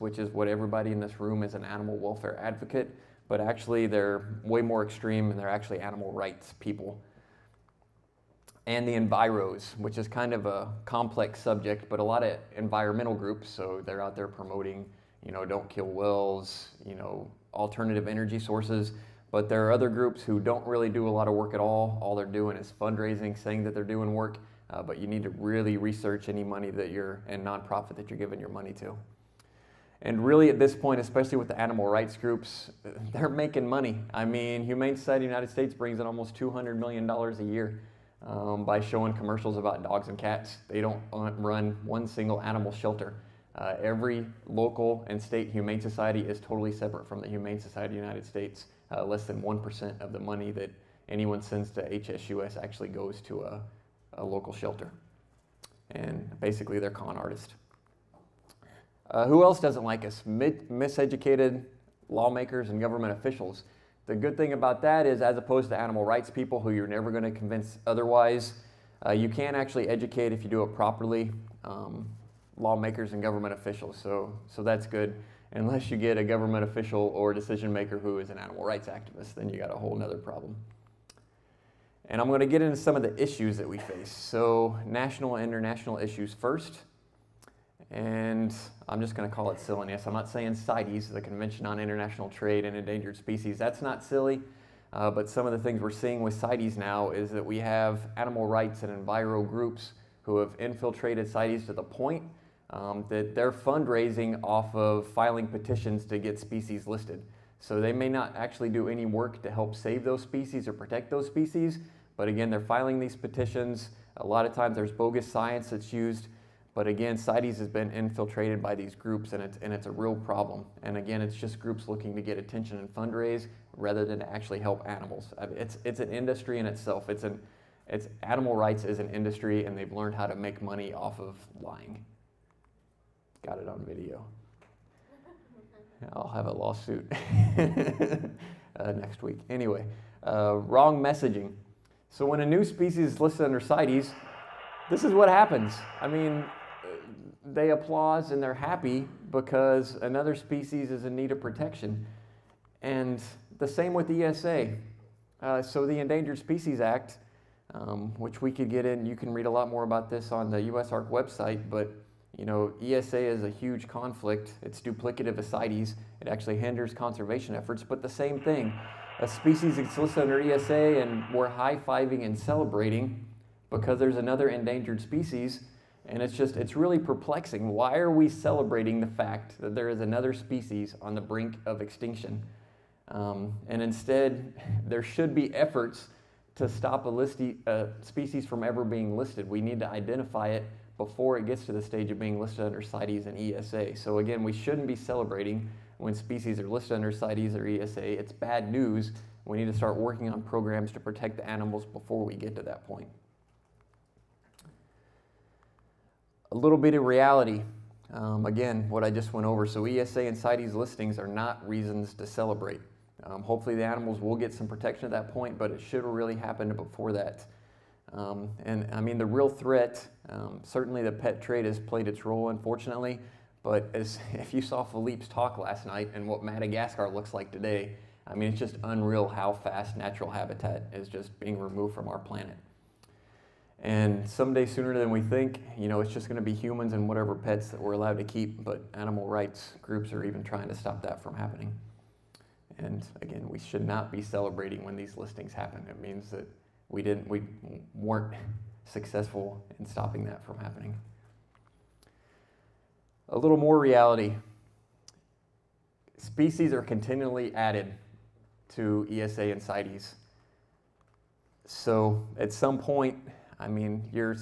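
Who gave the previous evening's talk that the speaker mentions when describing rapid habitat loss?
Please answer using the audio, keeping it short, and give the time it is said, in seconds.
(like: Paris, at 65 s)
Philippe, at 224 s.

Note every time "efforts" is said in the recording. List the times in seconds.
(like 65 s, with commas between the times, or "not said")
167 s, 185 s.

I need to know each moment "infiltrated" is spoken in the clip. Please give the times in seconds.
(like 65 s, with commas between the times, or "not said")
100 s, 117 s.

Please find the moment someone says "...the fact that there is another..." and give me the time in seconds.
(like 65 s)
178 s.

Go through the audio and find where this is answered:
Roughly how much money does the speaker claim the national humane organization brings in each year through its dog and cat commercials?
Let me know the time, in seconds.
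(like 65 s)
36 s.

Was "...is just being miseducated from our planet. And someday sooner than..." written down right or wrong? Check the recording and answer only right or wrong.
wrong.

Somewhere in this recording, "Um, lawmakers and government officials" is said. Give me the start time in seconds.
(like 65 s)
71 s.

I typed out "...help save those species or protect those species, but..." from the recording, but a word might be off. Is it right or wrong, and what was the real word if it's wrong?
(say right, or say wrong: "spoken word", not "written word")
right.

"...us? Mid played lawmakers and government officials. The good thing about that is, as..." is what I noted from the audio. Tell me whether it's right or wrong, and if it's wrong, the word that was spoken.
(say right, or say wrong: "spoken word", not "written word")
wrong: "miseducated", not "played".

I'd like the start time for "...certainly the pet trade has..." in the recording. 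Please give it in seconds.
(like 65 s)
220 s.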